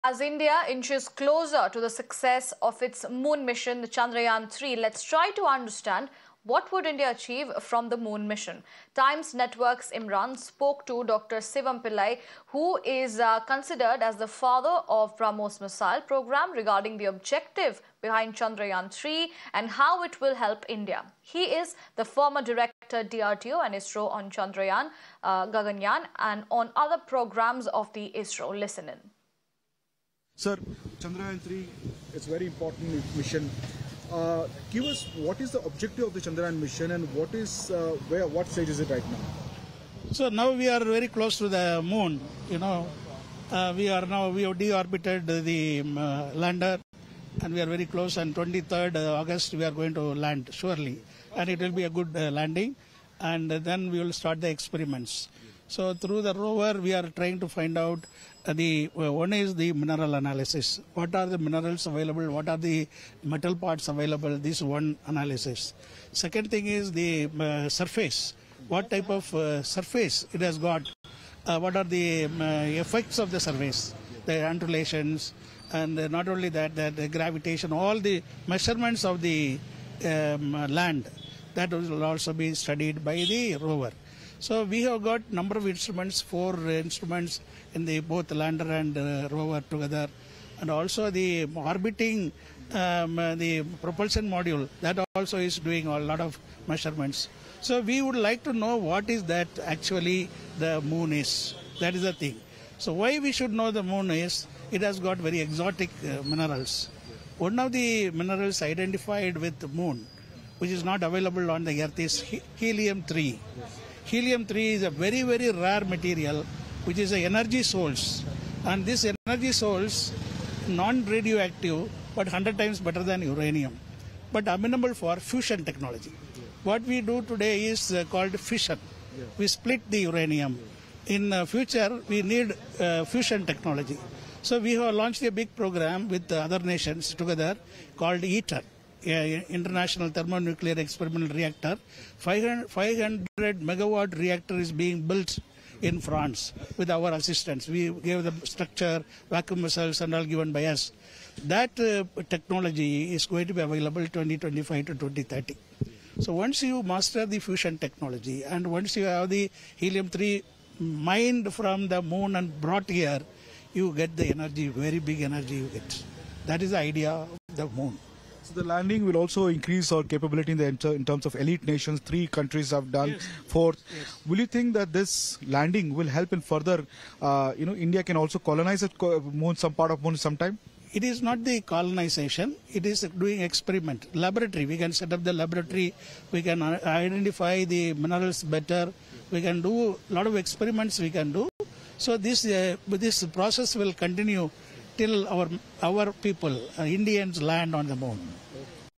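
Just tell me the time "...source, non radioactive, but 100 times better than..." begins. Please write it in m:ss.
1:59.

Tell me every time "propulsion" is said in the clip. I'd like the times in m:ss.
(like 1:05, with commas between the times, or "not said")
1:33.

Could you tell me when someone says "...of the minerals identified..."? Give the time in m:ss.
1:47.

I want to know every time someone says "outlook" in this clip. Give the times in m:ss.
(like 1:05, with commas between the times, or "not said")
not said.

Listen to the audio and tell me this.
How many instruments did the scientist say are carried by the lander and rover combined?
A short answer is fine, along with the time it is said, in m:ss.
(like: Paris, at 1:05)
4, at 1:26.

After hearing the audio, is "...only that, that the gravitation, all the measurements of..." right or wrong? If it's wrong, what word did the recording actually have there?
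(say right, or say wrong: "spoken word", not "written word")
right.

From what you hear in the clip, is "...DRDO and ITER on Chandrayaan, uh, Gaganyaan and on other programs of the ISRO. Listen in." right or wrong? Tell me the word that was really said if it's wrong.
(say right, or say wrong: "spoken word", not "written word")
wrong: "ISRO", not "ITER".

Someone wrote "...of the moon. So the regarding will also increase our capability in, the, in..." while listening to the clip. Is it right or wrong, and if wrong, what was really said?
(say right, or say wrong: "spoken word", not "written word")
wrong: "landing", not "regarding".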